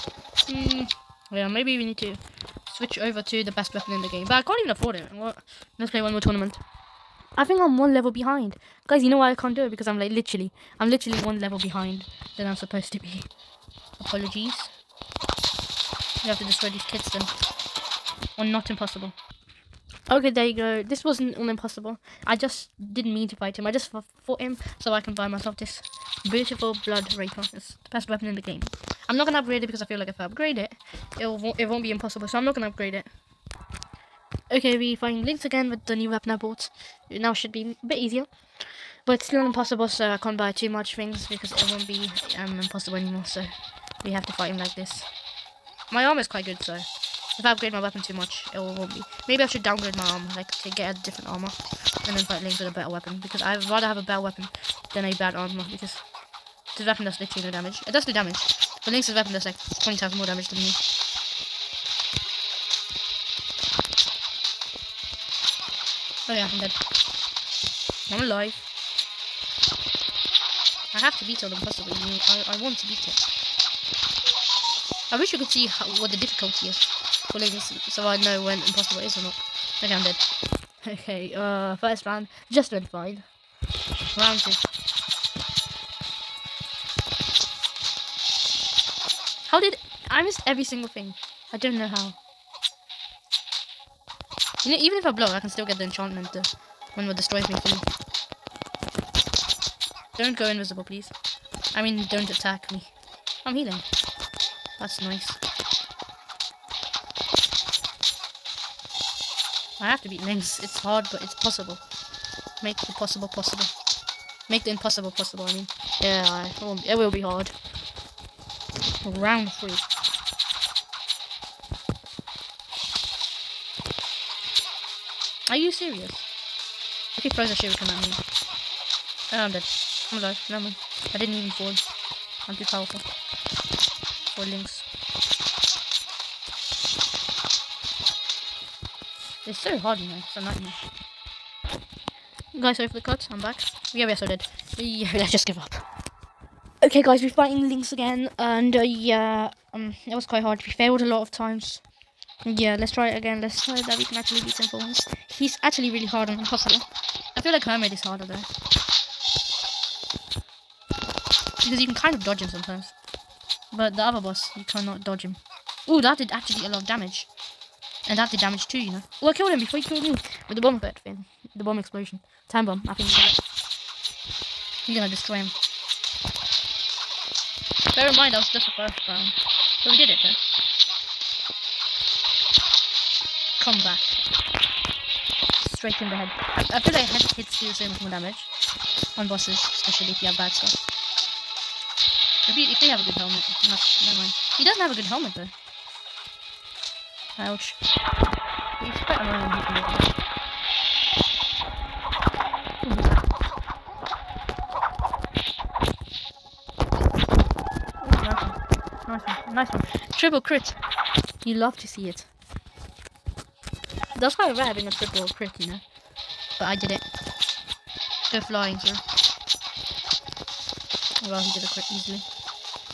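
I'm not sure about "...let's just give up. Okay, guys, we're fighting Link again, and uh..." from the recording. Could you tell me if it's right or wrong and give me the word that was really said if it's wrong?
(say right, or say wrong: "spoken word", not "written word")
wrong: "Lynx", not "Link".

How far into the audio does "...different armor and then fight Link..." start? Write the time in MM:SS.
00:51.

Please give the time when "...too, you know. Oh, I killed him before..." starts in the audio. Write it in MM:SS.
02:48.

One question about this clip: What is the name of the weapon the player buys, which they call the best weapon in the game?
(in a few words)
Blood Reaper.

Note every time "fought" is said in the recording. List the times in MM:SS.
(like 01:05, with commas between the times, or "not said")
00:24.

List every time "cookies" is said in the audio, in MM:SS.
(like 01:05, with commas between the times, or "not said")
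not said.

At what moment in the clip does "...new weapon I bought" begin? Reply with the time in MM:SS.
00:35.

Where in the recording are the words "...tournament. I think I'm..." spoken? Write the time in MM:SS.
00:06.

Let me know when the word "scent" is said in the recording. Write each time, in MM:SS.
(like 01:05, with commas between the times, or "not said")
not said.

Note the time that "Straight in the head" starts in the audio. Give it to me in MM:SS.
03:05.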